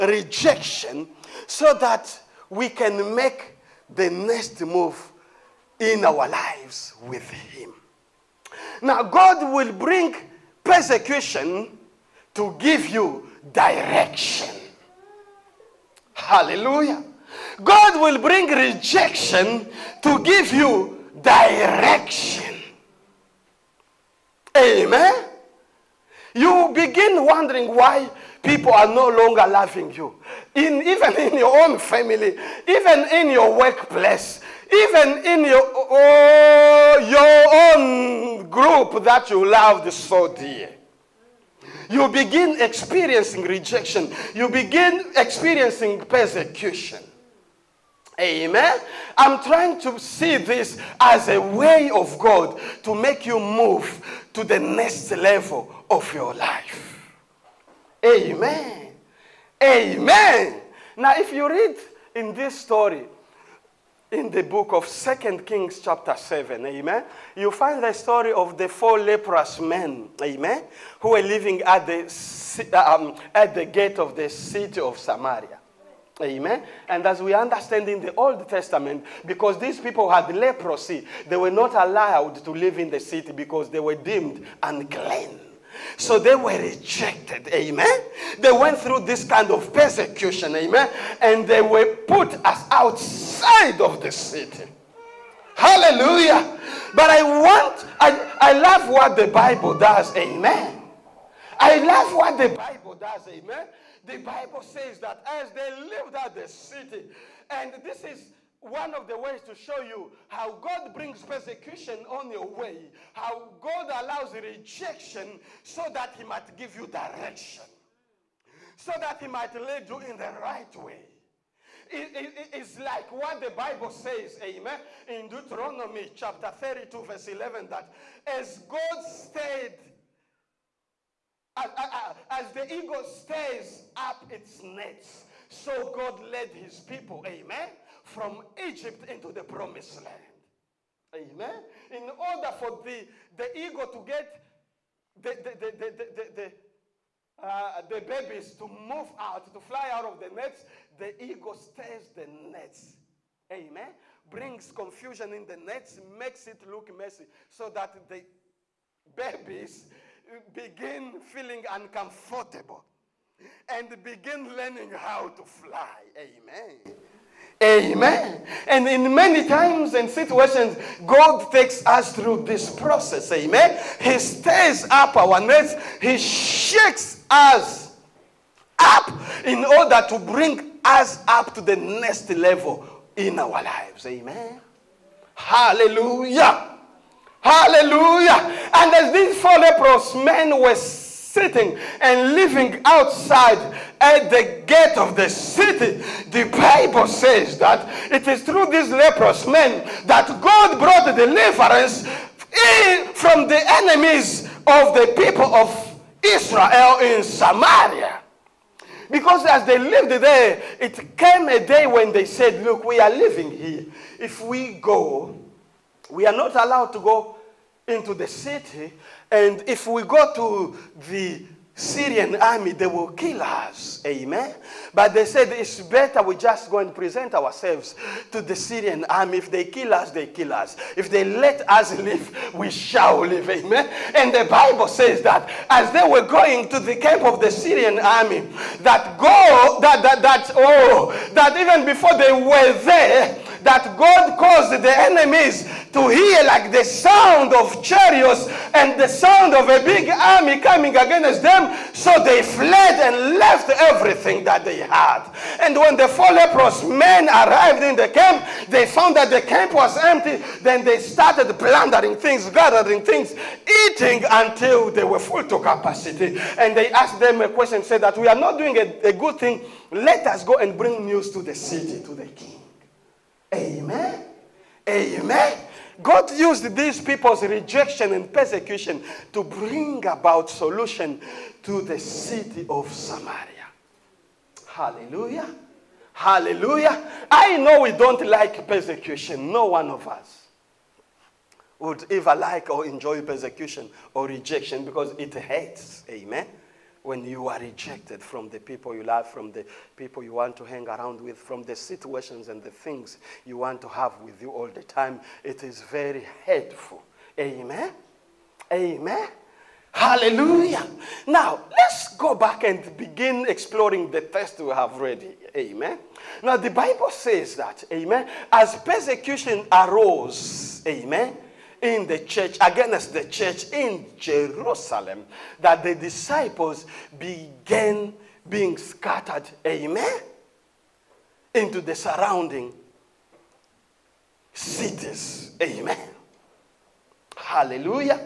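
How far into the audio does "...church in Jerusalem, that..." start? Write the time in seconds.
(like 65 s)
323 s.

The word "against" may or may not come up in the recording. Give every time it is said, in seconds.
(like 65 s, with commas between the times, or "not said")
250 s, 322 s.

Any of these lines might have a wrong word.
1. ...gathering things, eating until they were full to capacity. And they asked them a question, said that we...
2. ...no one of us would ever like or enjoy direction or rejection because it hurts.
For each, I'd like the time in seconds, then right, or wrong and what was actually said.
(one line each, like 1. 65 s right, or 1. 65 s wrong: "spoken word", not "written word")
1. 262 s right
2. 289 s wrong: "persecution", not "direction".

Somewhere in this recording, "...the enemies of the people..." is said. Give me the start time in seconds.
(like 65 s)
203 s.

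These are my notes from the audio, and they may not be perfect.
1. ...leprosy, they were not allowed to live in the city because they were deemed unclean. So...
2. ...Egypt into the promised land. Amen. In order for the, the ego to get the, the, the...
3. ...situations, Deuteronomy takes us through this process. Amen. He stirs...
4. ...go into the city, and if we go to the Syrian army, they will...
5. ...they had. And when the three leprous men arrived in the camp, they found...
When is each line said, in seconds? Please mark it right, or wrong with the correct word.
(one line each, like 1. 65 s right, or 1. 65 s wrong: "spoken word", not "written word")
1. 80 s right
2. 138 s right
3. 170 s wrong: "God", not "Deuteronomy"
4. 217 s right
5. 254 s wrong: "four", not "three".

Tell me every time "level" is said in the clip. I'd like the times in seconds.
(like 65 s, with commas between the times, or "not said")
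55 s, 182 s.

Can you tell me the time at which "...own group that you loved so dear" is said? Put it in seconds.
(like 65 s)
37 s.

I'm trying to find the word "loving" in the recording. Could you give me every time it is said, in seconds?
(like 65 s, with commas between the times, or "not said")
29 s.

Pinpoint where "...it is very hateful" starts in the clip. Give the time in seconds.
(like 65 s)
305 s.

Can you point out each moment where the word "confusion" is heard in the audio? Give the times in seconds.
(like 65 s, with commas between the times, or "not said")
154 s.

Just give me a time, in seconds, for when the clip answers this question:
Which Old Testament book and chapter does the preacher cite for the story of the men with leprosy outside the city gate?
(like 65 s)
64 s.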